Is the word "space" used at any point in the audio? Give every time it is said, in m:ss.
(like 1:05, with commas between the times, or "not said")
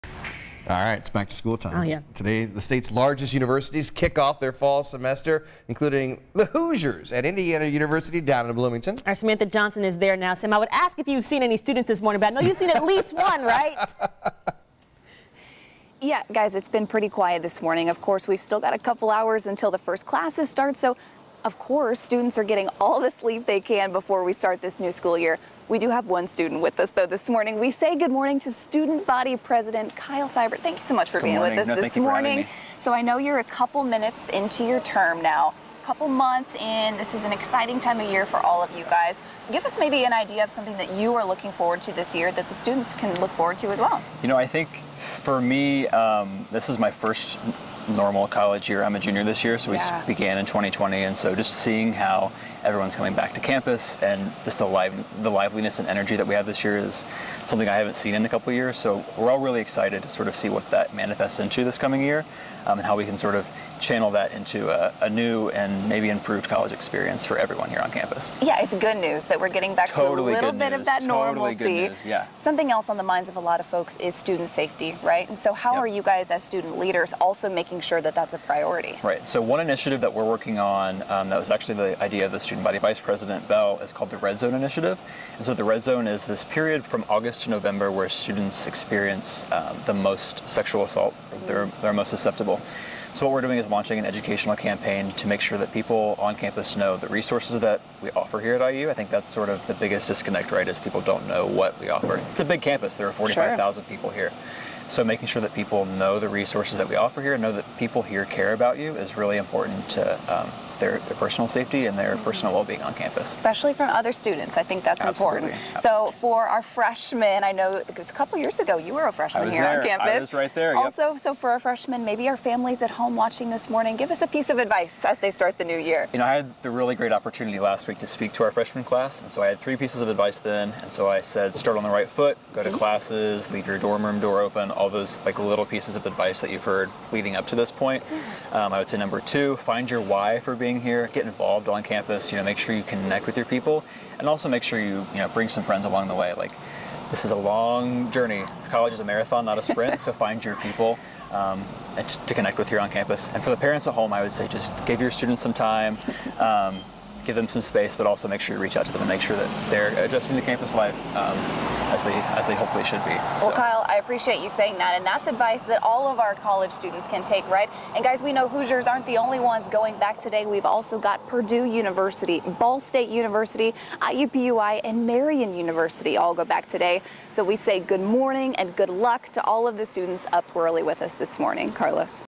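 2:37.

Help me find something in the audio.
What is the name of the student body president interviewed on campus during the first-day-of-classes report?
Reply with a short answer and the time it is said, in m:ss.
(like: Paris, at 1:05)
Kyle Seibert, at 0:29.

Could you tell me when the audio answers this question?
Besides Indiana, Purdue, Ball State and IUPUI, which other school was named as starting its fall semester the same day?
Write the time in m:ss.
2:55.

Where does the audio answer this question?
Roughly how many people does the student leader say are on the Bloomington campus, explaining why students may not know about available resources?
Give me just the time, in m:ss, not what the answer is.
1:43.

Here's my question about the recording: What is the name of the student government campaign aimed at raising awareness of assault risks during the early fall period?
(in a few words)
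Red Zone Initiative.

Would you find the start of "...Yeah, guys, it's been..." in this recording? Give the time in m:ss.
0:16.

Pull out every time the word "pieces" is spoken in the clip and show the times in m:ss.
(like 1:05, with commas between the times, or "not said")
2:04, 2:09, 2:15.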